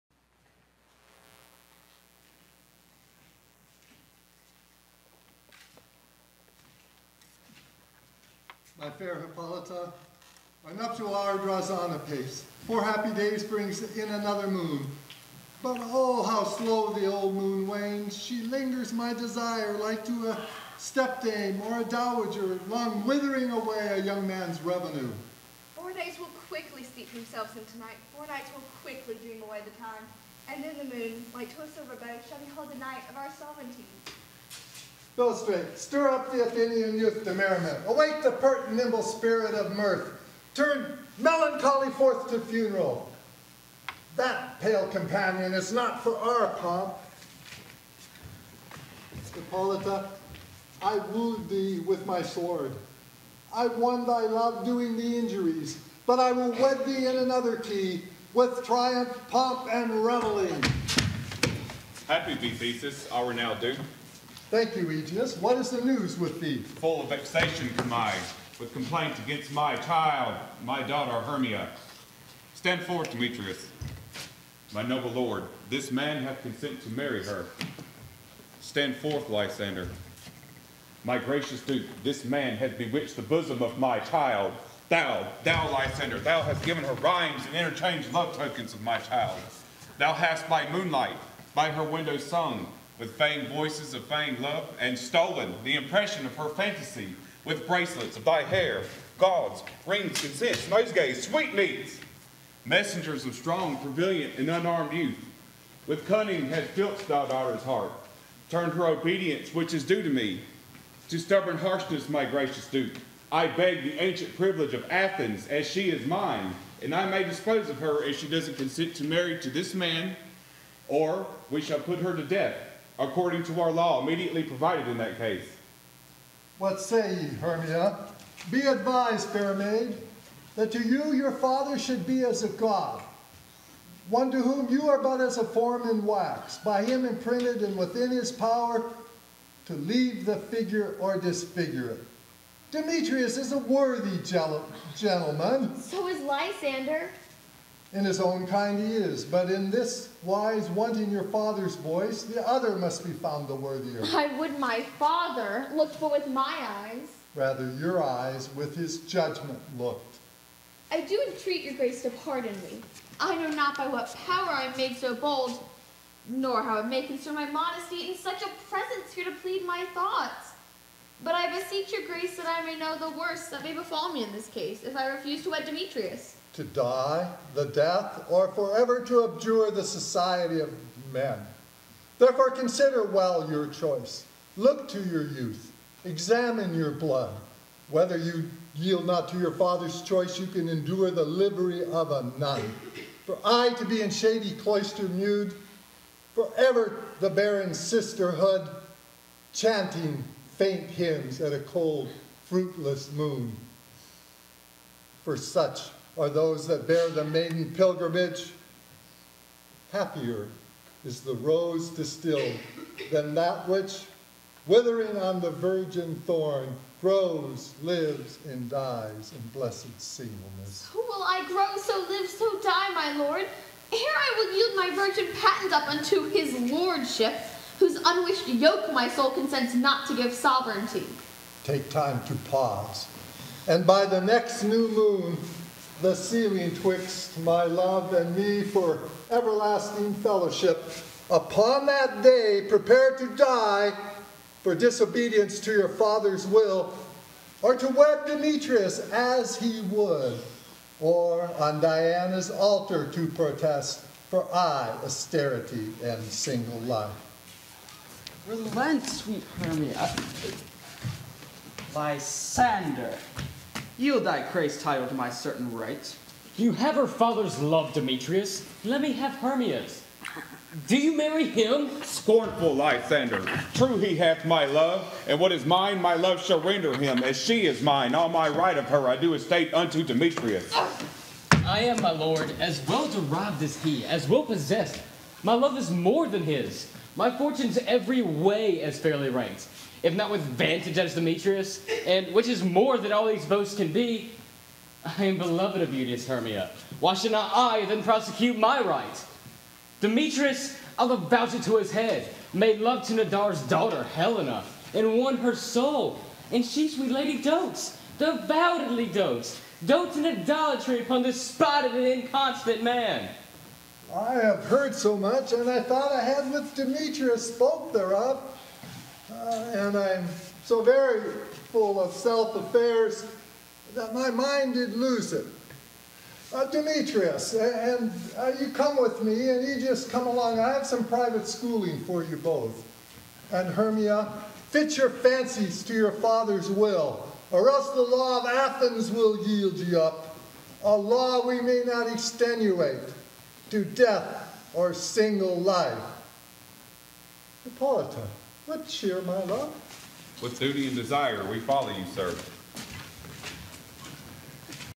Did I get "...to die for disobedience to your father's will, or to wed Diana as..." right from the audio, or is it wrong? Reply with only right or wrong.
wrong.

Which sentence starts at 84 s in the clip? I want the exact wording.
Thou, thou, Lysander, thou hast given her rhymes and interchanged love tokens of my child.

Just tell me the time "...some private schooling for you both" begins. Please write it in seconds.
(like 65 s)
330 s.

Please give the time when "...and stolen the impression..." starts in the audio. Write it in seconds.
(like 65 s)
94 s.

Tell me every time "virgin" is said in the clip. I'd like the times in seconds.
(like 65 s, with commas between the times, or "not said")
215 s, 224 s.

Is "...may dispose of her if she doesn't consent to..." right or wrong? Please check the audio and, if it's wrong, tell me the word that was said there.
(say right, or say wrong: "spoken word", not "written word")
right.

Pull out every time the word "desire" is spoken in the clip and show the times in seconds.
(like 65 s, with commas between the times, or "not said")
19 s, 350 s.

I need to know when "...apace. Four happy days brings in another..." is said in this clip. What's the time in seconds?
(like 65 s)
11 s.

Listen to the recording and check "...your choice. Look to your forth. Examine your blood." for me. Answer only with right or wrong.
wrong.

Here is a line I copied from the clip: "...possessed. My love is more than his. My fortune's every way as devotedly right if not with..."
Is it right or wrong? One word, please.
wrong.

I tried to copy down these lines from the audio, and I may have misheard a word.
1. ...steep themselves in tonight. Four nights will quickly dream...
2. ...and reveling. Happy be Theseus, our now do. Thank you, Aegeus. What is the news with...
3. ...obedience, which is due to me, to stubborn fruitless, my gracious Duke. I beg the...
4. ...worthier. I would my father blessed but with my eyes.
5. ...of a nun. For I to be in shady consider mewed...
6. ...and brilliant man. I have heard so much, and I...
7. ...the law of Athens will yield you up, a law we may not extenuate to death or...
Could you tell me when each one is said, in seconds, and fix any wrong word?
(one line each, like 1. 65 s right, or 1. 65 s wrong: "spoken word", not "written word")
1. 26 s right
2. 59 s right
3. 108 s wrong: "harshness", not "fruitless"
4. 153 s wrong: "looked", not "blessed"
5. 191 s wrong: "cloister", not "consider"
6. 311 s wrong: "inconstant", not "brilliant"
7. 337 s right.